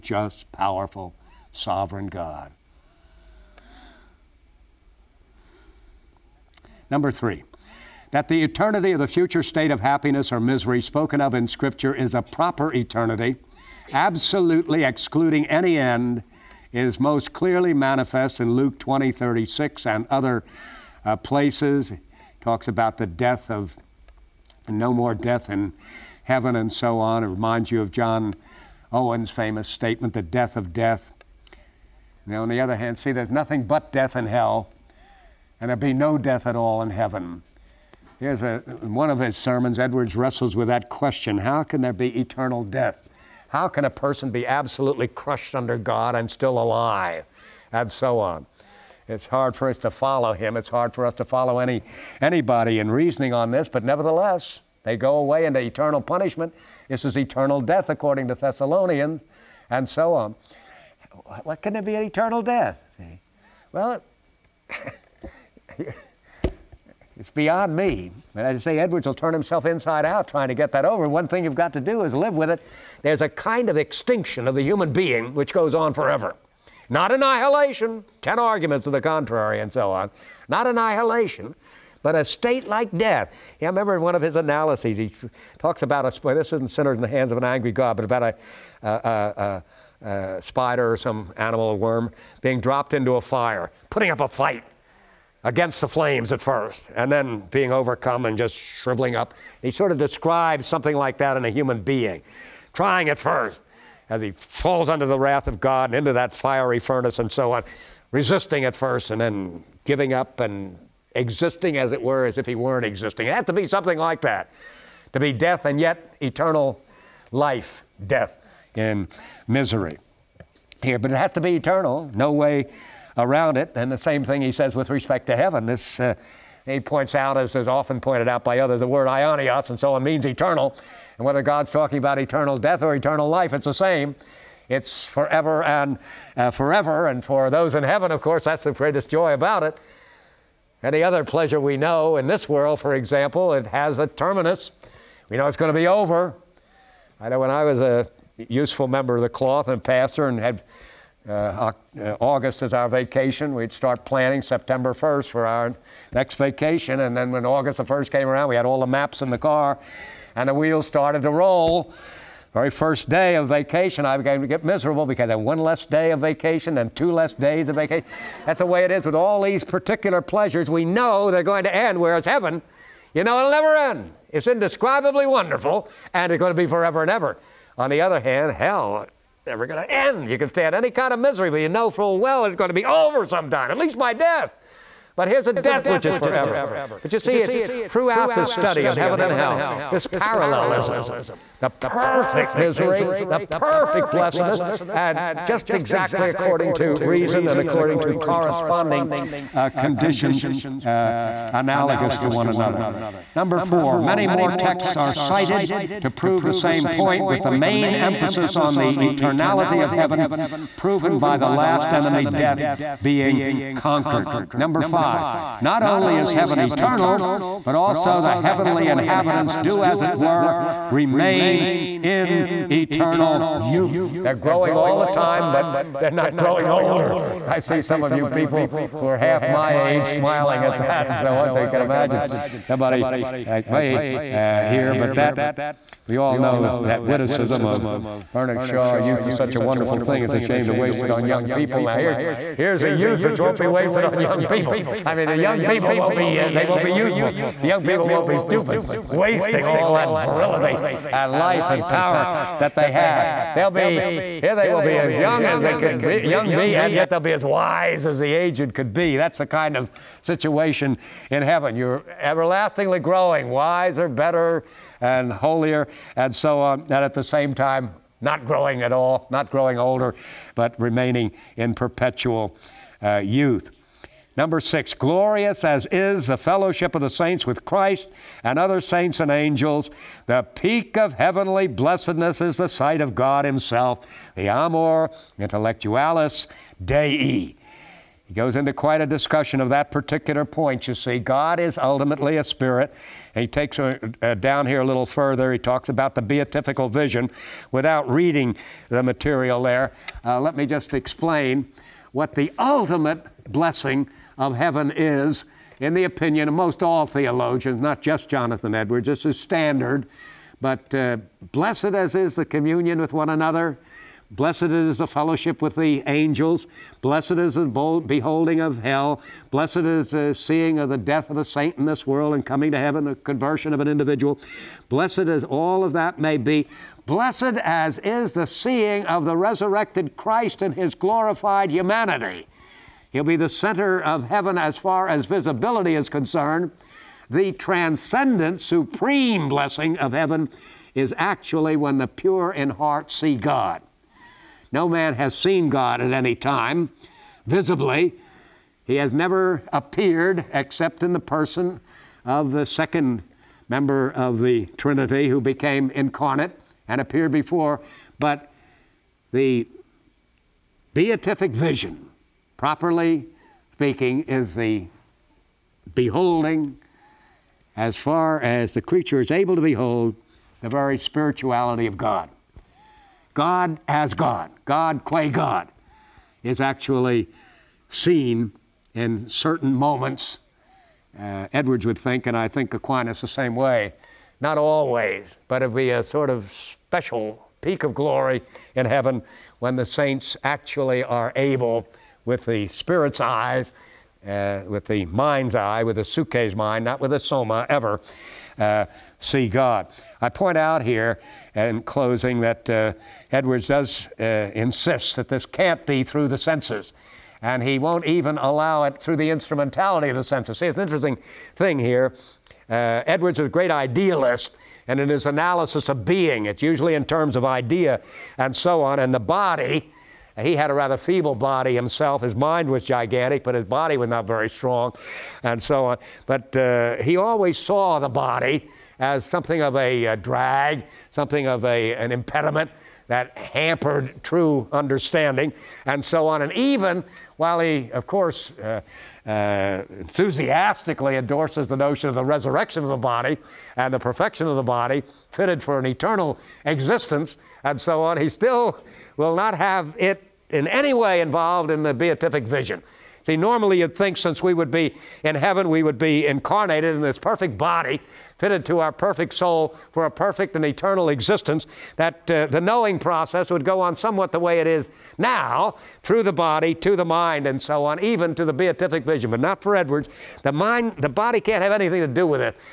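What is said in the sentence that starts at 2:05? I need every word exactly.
This uh, he points out, as is often pointed out by others, the word aionios, and so on means eternal.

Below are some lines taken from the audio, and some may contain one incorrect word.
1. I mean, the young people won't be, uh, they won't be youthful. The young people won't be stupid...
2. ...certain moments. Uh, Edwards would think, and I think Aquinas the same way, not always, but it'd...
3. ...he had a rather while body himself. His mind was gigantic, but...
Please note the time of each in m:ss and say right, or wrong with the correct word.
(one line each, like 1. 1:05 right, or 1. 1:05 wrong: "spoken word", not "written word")
1. 4:05 right
2. 6:19 right
3. 7:00 wrong: "feeble", not "while".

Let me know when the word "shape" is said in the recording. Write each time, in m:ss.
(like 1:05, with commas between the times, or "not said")
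not said.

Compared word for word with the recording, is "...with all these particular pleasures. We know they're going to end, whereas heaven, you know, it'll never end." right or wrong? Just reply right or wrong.
right.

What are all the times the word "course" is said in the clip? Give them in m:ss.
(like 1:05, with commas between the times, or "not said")
2:18, 7:18.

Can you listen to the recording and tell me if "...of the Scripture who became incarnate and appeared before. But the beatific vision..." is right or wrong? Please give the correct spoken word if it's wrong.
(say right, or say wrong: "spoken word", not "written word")
wrong: "Trinity", not "Scripture".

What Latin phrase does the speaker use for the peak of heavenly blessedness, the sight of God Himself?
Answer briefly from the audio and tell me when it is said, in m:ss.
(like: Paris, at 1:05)
amor intellectualis Dei, at 4:44.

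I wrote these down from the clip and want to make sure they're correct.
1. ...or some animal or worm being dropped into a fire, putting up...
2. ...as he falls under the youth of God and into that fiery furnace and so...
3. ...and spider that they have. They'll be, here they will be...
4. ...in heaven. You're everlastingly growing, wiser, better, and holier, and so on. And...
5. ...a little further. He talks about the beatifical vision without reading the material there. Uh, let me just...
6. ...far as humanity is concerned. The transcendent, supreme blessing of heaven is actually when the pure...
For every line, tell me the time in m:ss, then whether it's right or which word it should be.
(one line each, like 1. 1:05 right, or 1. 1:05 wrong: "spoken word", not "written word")
1. 1:30 right
2. 1:44 wrong: "wrath", not "youth"
3. 4:11 wrong: "power", not "spider"
4. 4:21 right
5. 4:54 right
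6. 5:34 wrong: "visibility", not "humanity".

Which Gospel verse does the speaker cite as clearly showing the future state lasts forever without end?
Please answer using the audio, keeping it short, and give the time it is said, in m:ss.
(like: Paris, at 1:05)
Luke 20:36, at 0:18.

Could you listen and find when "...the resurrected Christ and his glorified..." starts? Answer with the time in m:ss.
5:29.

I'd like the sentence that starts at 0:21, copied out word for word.
It talks about the death of, no more death in heaven and so on.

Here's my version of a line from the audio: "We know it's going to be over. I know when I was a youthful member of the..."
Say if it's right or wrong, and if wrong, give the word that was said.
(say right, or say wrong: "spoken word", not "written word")
wrong: "useful", not "youthful".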